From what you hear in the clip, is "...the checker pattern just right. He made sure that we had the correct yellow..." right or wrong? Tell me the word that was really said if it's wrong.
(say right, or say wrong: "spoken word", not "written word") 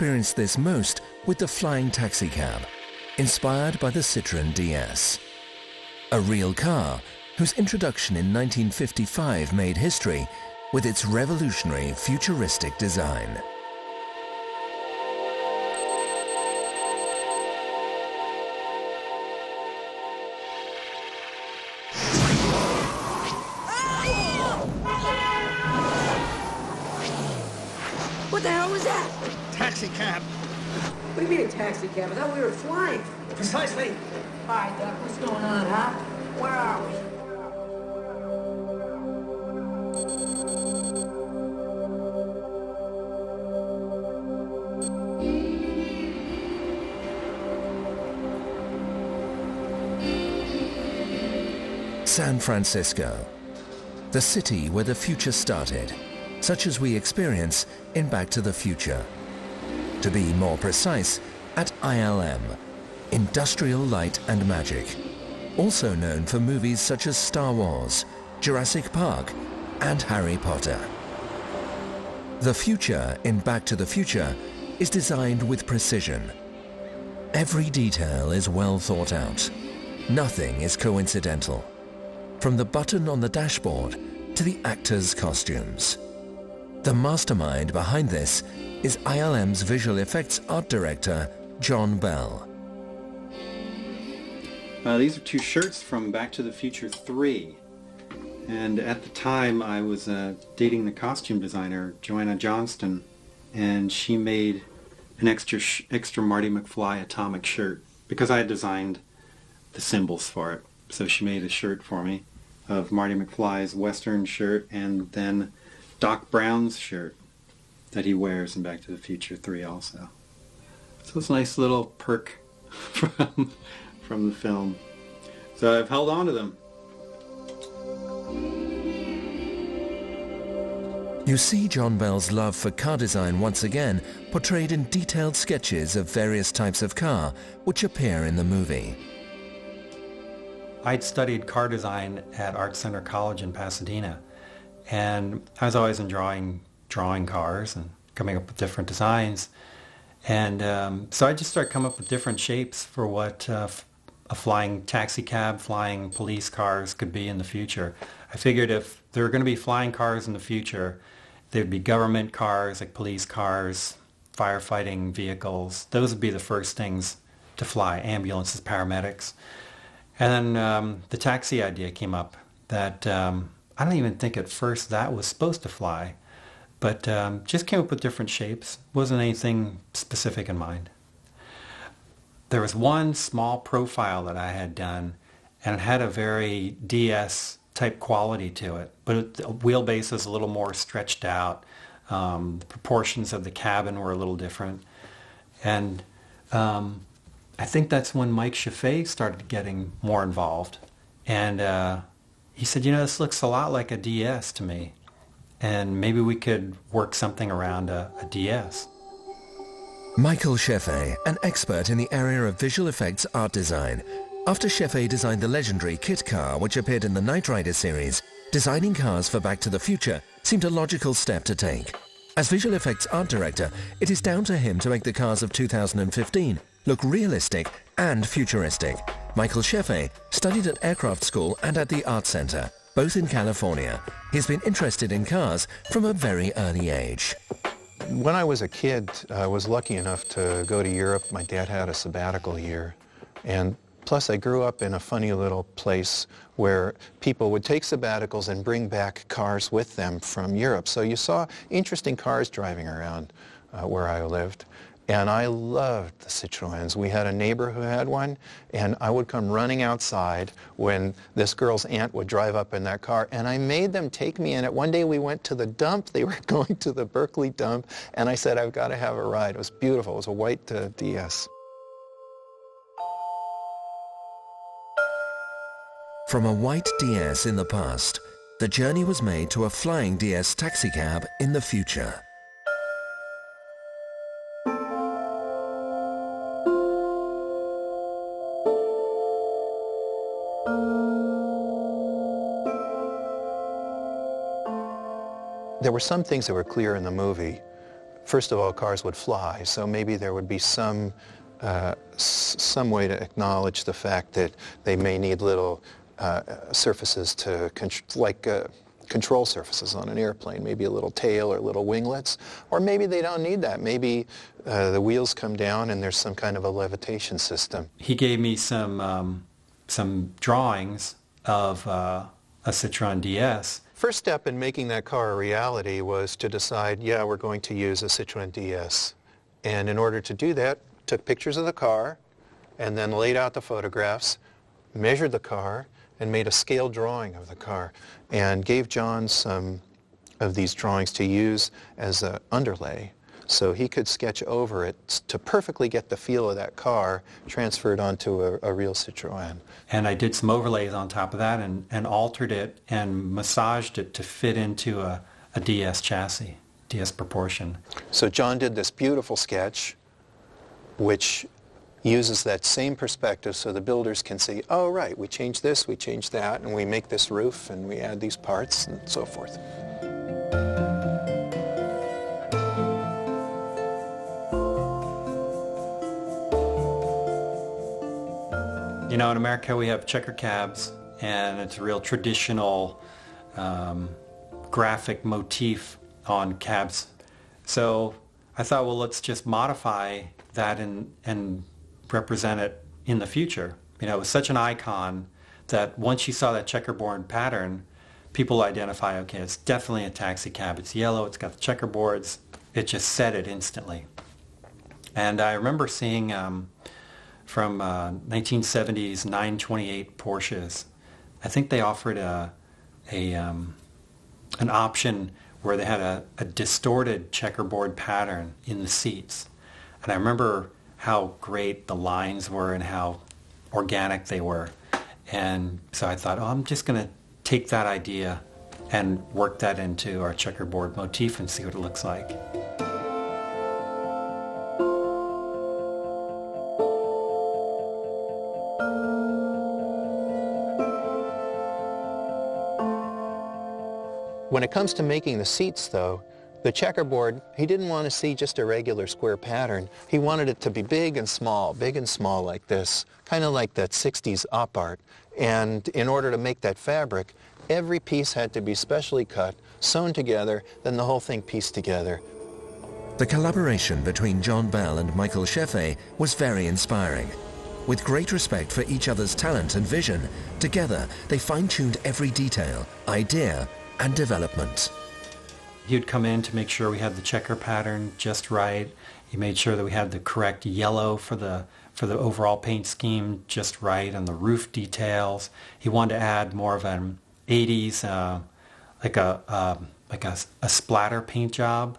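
right.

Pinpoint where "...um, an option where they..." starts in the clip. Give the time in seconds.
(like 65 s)
413 s.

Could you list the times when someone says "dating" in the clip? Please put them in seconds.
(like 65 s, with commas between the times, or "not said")
100 s.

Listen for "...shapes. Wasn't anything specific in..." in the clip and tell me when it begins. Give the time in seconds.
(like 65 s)
178 s.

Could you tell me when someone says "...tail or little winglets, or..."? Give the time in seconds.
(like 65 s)
311 s.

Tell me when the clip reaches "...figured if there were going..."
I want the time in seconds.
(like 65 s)
158 s.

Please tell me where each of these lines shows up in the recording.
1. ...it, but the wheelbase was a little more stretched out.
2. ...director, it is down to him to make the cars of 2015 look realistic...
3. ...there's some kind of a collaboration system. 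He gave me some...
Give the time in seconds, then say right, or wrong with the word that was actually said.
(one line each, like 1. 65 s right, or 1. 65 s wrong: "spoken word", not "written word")
1. 188 s right
2. 223 s right
3. 316 s wrong: "levitation", not "collaboration".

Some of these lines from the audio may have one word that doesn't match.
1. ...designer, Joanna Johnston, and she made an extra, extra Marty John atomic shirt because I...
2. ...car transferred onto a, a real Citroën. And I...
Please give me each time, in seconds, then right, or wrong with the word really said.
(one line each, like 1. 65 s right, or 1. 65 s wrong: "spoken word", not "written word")
1. 101 s wrong: "McFly", not "John"
2. 346 s right.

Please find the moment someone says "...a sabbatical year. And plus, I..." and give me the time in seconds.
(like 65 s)
241 s.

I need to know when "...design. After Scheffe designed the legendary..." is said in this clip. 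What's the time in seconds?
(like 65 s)
213 s.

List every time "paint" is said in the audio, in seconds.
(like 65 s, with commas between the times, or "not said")
482 s, 491 s.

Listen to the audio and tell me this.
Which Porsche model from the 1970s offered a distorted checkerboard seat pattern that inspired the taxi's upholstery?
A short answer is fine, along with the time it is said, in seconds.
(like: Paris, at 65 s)
928, at 409 s.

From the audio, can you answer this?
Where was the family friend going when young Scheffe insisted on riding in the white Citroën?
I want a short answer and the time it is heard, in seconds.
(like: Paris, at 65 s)
The Berkeley dump, at 267 s.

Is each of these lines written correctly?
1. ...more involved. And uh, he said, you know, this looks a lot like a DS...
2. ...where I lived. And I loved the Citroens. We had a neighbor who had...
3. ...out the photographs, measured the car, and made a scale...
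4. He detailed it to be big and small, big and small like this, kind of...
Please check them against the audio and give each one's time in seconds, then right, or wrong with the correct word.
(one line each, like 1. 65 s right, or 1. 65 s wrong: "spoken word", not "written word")
1. 200 s right
2. 253 s right
3. 333 s right
4. 450 s wrong: "wanted", not "detailed".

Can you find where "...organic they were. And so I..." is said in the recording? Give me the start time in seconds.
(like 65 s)
423 s.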